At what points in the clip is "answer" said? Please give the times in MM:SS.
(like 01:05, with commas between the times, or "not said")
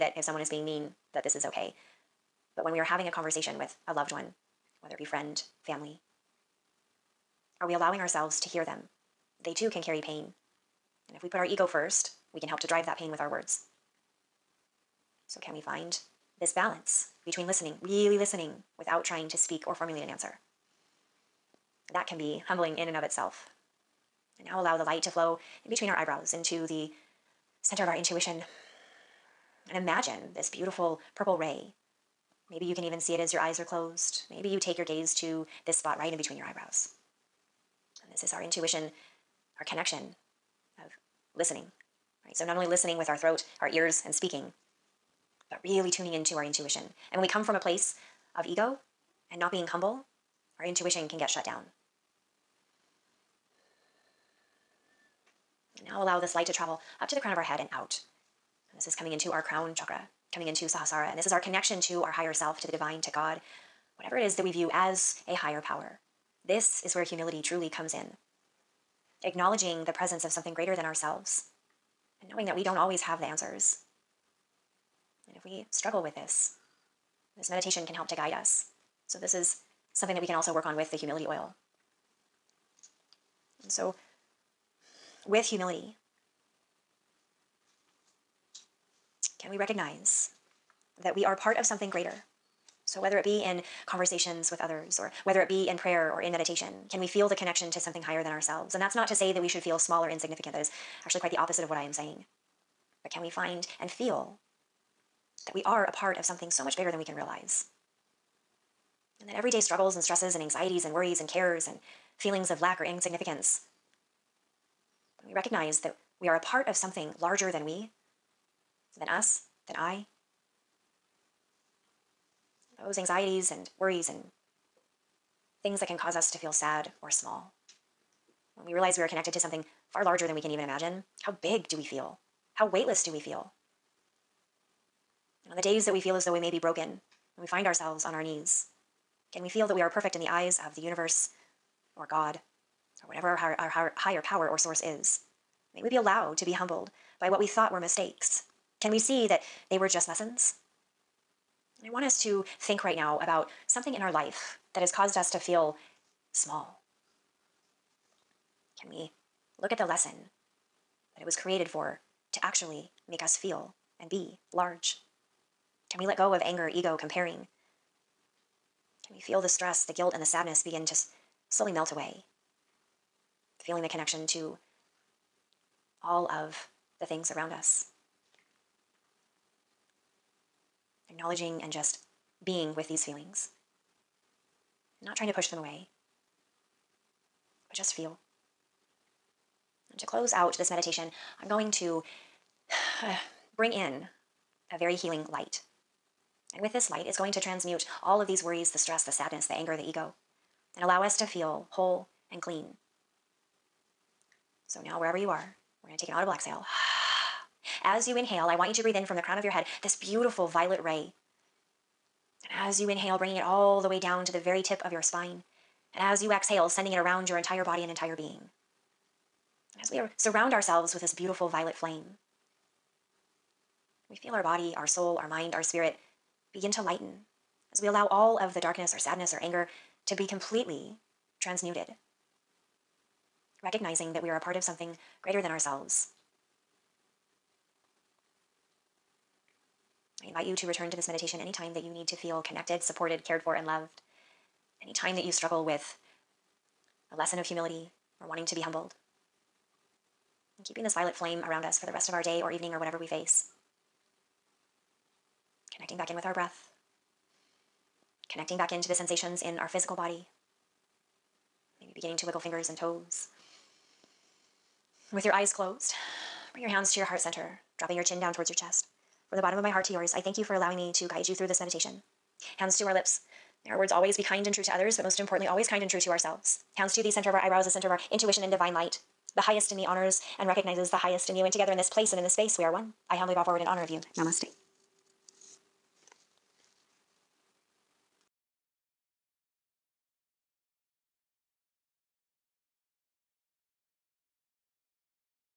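00:20, 01:13.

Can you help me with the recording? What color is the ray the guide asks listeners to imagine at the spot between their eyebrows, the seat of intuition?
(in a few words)
purple.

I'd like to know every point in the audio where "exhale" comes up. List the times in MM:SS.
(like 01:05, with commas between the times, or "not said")
03:26, 03:36.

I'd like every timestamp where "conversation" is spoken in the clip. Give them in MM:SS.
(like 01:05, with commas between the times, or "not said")
00:03, 01:33.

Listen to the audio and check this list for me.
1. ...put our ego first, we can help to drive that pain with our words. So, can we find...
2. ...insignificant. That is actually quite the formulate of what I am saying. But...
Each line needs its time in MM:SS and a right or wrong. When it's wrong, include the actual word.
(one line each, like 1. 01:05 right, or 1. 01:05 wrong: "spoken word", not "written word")
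1. 00:11 right
2. 01:40 wrong: "opposite", not "formulate".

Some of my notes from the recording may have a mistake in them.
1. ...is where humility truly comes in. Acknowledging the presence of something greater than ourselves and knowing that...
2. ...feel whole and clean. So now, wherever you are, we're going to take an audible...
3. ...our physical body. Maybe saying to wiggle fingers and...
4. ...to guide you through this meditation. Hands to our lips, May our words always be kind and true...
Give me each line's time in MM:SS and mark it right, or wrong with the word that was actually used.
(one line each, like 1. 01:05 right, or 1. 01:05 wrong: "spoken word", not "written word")
1. 01:06 right
2. 03:21 right
3. 04:19 wrong: "beginning", not "saying"
4. 04:30 right.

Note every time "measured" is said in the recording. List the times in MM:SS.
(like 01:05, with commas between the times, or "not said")
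not said.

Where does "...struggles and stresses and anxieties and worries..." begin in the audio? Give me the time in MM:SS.
01:49.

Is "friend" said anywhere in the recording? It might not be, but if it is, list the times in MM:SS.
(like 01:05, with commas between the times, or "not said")
00:05.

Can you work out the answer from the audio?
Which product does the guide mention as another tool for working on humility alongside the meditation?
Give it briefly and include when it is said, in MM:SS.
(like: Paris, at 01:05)
humility oil, at 01:20.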